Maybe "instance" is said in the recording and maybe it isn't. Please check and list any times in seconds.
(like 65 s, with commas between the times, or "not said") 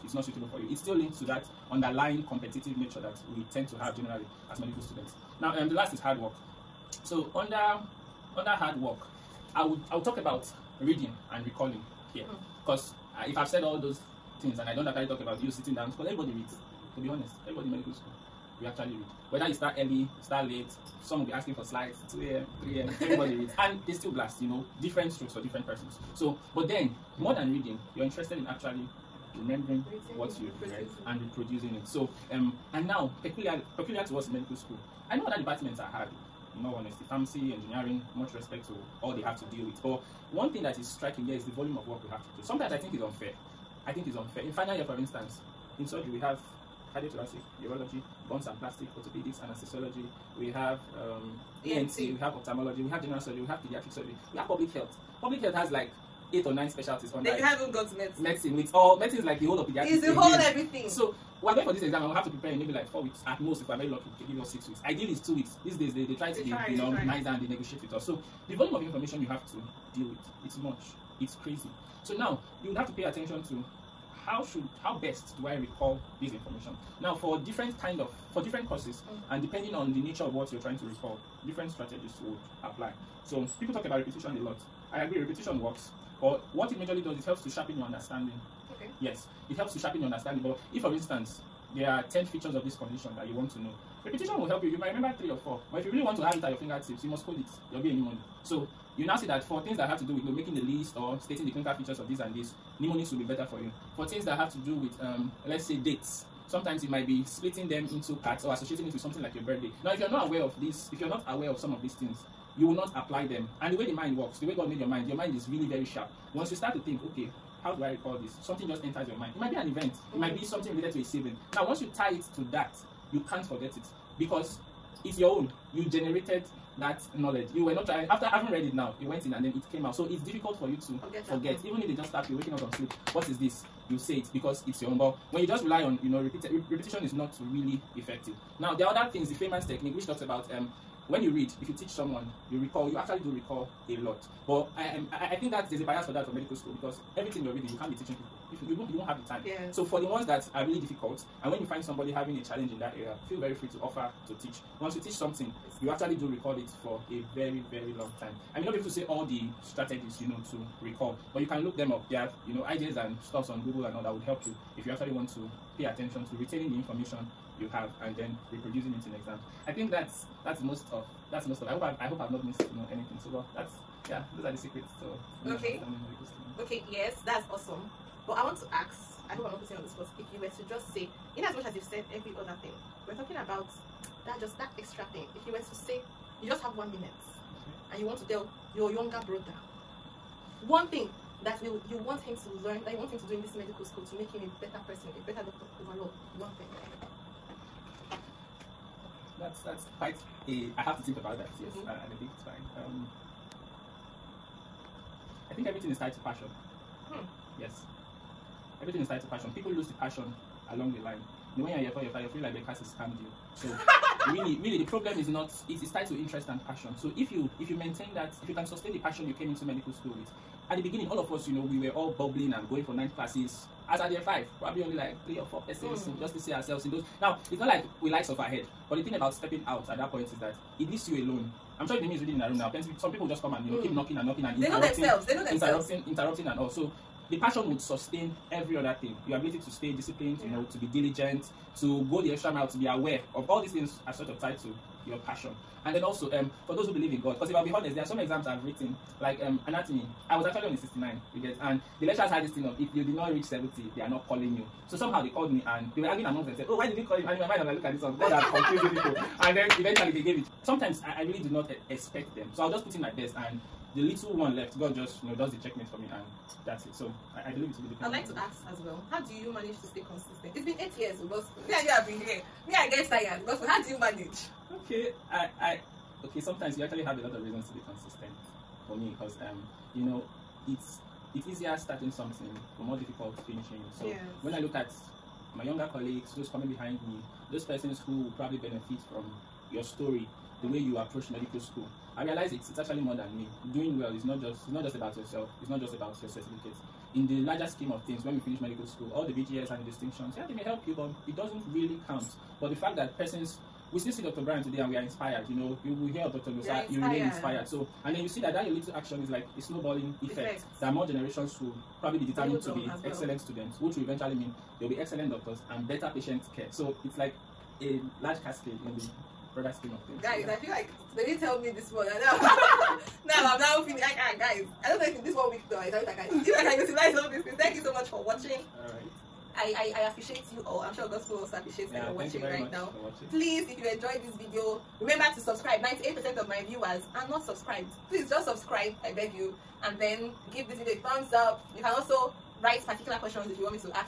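44 s, 90 s.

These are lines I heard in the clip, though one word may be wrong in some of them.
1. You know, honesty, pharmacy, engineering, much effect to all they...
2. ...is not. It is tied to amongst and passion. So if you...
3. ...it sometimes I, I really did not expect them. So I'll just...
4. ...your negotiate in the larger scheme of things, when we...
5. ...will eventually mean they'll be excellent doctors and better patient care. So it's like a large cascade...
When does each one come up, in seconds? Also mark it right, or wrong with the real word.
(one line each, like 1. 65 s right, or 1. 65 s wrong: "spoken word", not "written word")
1. 36 s wrong: "respect", not "effect"
2. 215 s wrong: "interest", not "amongst"
3. 260 s right
4. 296 s wrong: "certificate", not "negotiate"
5. 313 s right.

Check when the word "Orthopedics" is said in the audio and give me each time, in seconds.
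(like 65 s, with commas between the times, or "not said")
48 s.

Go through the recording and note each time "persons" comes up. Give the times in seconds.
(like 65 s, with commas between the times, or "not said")
25 s, 194 s, 225 s, 287 s, 303 s.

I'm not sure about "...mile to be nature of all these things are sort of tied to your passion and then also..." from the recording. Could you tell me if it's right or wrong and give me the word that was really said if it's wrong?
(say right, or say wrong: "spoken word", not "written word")
wrong: "aware", not "nature".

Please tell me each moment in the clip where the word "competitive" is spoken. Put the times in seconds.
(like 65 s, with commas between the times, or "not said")
2 s.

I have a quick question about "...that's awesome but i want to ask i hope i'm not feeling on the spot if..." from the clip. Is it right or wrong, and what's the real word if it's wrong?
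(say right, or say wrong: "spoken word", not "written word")
wrong: "putting", not "feeling".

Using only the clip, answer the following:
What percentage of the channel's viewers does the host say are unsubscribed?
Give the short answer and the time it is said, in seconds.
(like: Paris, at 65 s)
98%, at 335 s.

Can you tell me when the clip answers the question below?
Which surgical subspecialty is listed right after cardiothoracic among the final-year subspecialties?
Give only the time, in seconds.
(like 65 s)
47 s.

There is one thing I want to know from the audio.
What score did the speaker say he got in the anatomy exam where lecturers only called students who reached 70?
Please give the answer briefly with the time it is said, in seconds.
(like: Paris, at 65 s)
69, at 250 s.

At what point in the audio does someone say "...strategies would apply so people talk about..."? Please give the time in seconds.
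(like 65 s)
81 s.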